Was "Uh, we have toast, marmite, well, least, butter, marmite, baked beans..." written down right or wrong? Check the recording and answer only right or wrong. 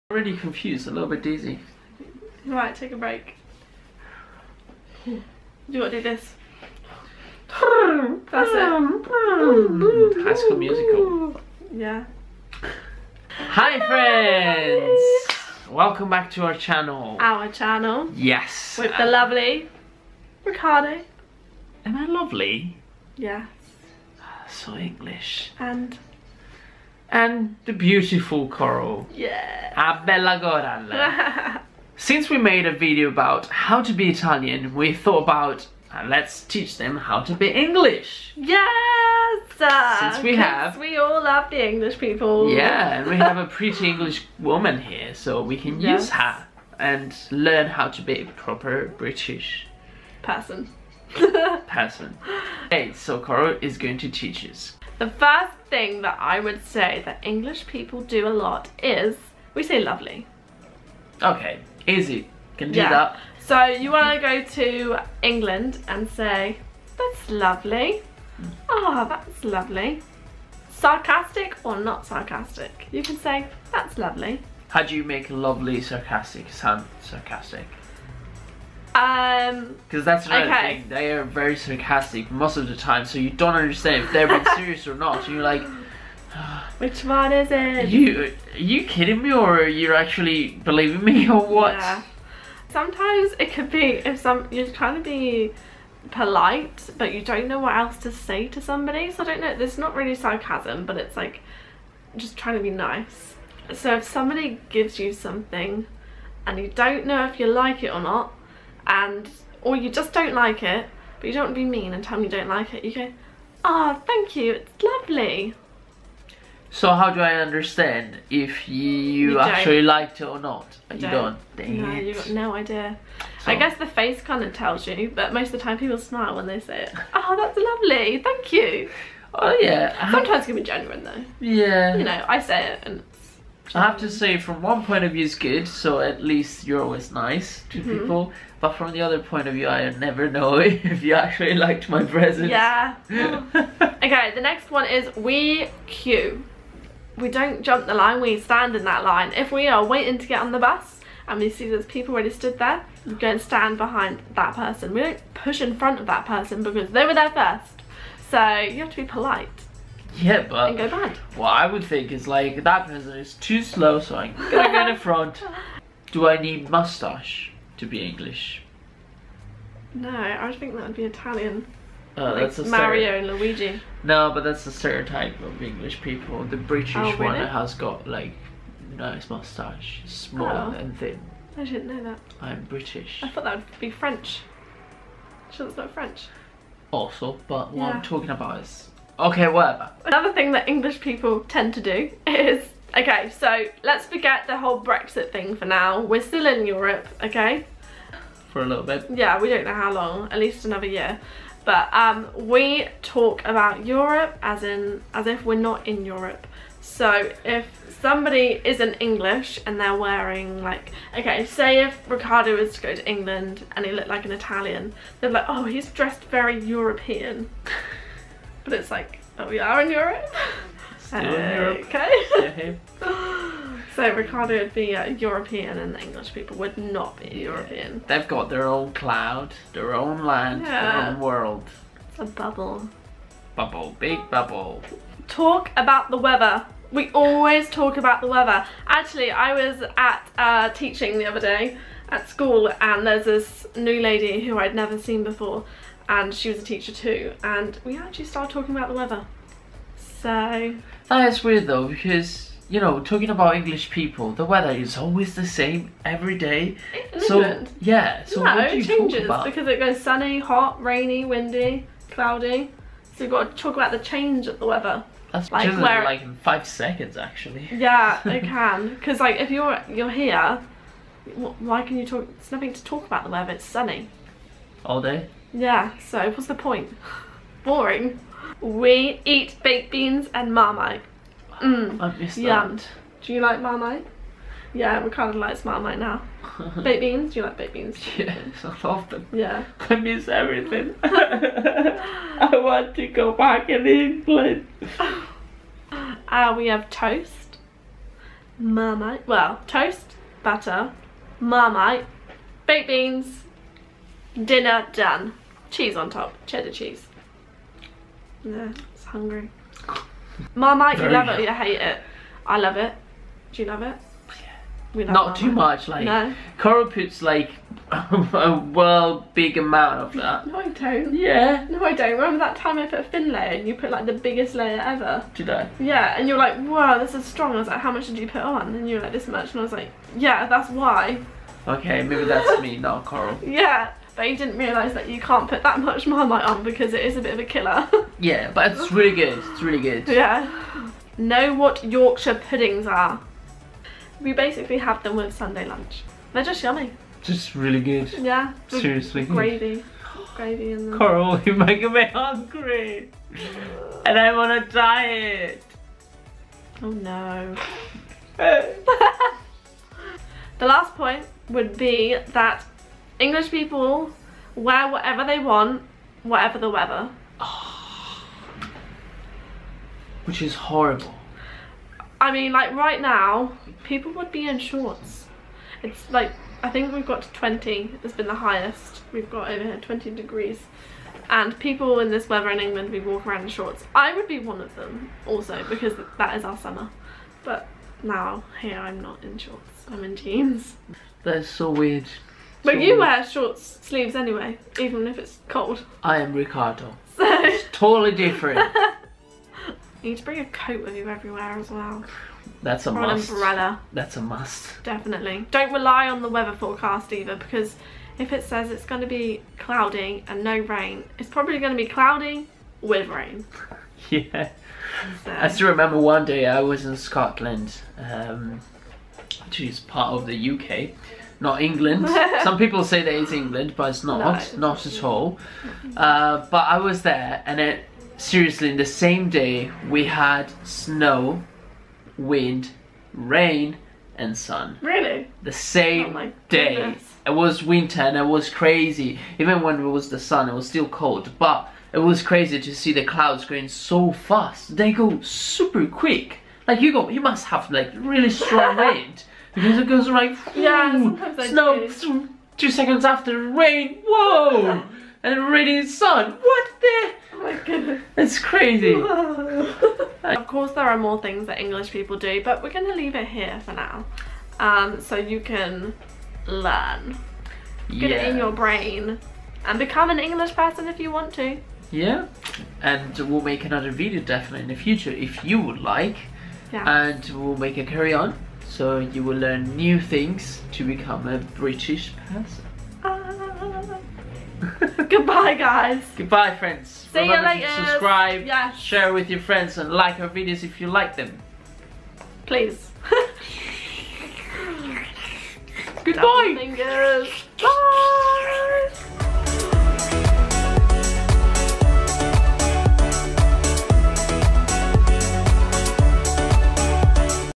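wrong.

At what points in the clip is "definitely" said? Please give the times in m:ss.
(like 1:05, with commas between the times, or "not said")
6:44, 7:54.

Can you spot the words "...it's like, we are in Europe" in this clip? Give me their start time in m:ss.
3:38.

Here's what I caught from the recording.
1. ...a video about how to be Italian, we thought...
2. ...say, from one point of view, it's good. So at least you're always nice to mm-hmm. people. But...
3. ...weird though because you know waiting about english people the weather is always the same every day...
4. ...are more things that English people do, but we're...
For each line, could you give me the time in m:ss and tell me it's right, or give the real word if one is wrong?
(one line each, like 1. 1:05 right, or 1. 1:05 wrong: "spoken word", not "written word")
1. 0:32 right
2. 2:14 right
3. 4:11 wrong: "talking", not "waiting"
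4. 7:40 right.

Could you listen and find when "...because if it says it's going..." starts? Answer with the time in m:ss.
6:47.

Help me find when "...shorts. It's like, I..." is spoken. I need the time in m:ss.
6:14.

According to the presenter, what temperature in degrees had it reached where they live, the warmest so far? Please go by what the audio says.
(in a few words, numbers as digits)
20 degrees.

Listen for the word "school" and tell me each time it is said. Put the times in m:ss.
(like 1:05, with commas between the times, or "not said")
0:10, 4:02.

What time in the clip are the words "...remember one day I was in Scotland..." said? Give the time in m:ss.
6:55.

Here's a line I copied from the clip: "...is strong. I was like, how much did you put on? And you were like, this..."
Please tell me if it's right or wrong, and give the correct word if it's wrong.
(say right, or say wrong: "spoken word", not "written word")
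right.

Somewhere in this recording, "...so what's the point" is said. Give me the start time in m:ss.
4:35.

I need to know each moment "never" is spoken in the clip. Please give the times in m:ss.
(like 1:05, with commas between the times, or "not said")
2:19, 4:04.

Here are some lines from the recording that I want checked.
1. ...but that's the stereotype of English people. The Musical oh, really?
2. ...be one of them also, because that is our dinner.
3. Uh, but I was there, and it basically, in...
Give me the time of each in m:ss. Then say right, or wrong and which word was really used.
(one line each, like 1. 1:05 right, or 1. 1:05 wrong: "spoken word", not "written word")
1. 2:54 wrong: "British", not "Musical"
2. 6:24 wrong: "summer", not "dinner"
3. 7:05 wrong: "seriously", not "basically".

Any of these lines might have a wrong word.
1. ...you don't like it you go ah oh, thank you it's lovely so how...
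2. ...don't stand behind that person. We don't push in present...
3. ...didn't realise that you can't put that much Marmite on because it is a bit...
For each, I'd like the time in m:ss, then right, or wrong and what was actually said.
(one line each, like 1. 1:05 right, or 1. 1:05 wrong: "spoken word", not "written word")
1. 1:52 right
2. 2:33 wrong: "front", not "present"
3. 5:34 right.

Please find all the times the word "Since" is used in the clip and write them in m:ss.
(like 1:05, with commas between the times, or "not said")
0:31, 0:40.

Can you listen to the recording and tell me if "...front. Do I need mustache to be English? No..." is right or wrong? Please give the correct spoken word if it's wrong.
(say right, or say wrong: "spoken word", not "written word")
right.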